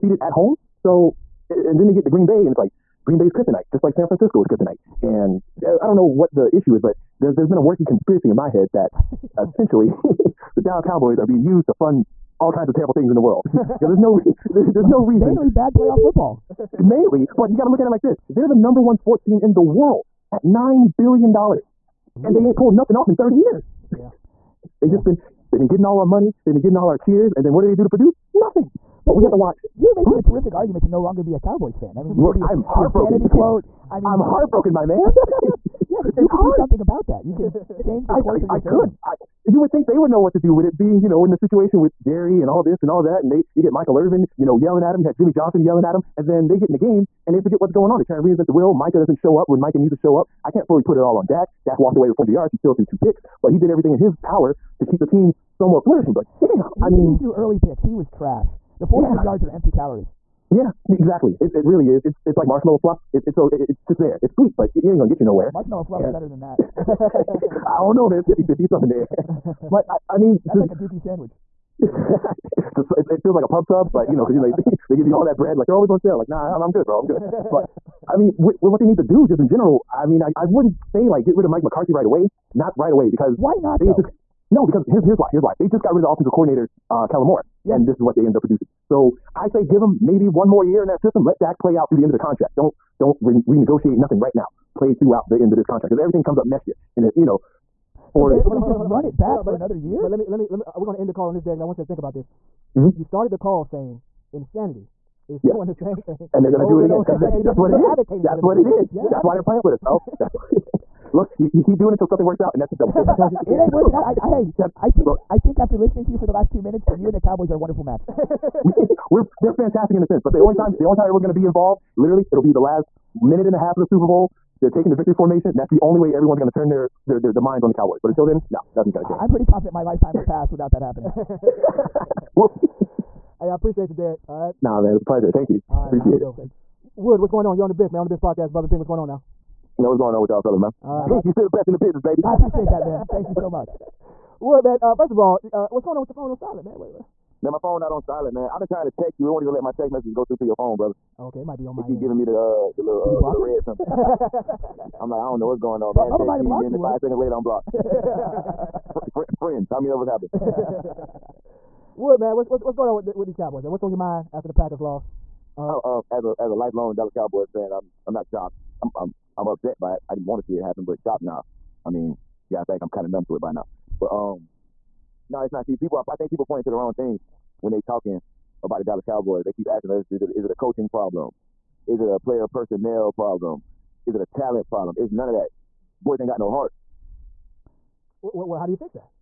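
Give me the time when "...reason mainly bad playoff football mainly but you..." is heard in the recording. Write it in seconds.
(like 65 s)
15 s.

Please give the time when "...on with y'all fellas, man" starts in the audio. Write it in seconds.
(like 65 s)
140 s.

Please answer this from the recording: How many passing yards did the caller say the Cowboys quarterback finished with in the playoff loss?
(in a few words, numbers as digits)
400.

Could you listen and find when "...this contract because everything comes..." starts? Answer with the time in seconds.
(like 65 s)
95 s.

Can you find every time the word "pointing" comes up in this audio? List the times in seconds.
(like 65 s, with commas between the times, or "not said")
176 s.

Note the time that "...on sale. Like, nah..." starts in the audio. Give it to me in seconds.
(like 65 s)
75 s.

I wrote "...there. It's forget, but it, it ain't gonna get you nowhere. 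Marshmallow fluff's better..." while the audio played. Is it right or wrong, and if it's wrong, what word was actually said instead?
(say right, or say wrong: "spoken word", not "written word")
wrong: "sweet", not "forget".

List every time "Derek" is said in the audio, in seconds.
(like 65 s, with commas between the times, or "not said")
101 s, 133 s.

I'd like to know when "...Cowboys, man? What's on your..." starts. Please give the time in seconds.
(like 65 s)
163 s.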